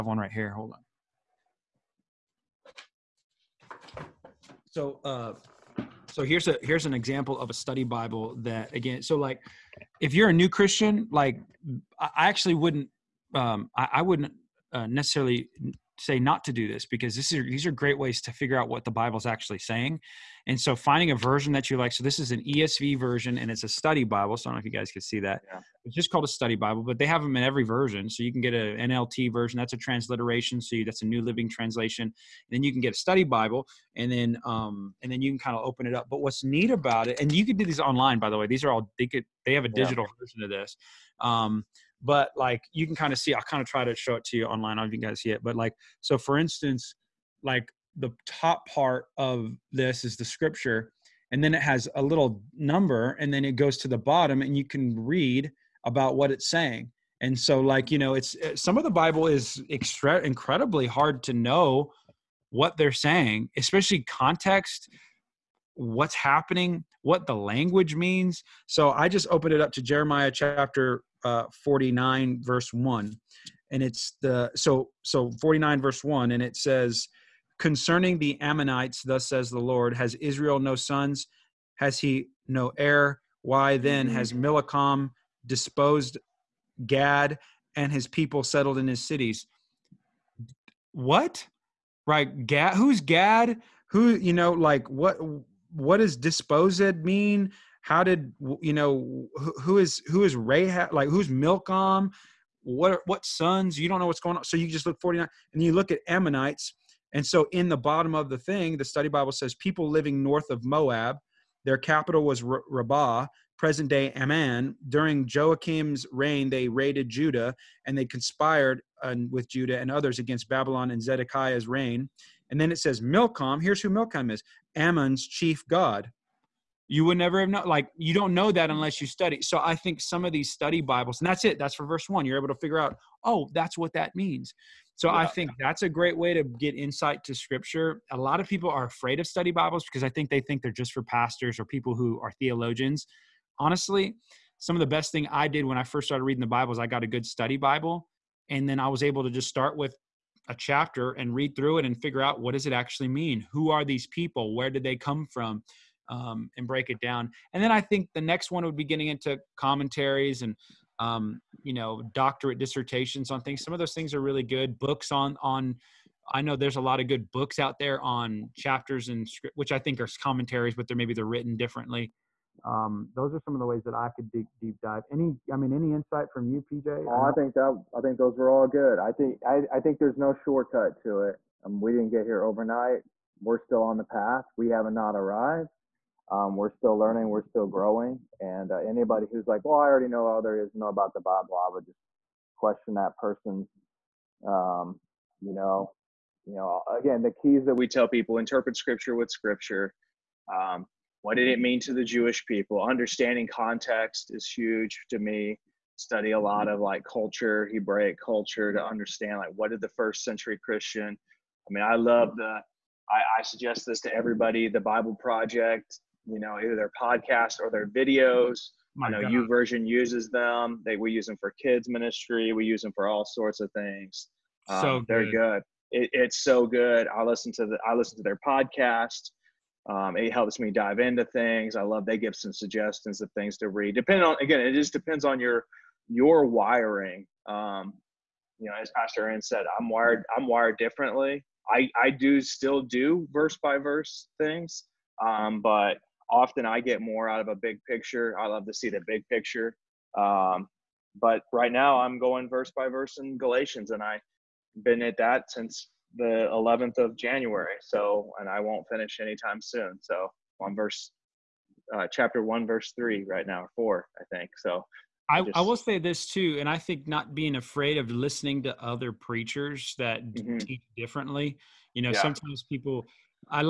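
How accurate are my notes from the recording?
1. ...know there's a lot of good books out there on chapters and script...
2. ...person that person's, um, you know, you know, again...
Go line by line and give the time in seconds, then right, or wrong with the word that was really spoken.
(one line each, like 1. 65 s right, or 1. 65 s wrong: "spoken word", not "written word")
1. 166 s right
2. 192 s wrong: "question", not "person".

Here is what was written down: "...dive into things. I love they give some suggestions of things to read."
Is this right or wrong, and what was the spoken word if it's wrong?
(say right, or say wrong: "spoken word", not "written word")
right.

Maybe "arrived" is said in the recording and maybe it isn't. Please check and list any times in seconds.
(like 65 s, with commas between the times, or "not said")
185 s.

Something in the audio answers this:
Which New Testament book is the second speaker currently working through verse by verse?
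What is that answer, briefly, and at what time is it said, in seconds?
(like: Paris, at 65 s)
Galatians, at 253 s.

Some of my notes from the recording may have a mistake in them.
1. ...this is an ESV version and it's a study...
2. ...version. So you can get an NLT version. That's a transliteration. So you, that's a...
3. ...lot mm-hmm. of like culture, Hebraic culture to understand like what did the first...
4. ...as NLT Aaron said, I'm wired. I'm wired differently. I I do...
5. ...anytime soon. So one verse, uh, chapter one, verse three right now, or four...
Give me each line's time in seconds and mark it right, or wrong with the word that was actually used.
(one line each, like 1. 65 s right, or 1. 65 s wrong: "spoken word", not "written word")
1. 22 s right
2. 27 s right
3. 206 s right
4. 238 s wrong: "Pastor", not "NLT"
5. 259 s right.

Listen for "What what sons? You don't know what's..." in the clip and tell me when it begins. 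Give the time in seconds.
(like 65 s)
102 s.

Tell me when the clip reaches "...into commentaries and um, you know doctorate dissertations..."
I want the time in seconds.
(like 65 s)
159 s.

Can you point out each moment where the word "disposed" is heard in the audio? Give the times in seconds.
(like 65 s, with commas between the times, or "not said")
85 s, 96 s.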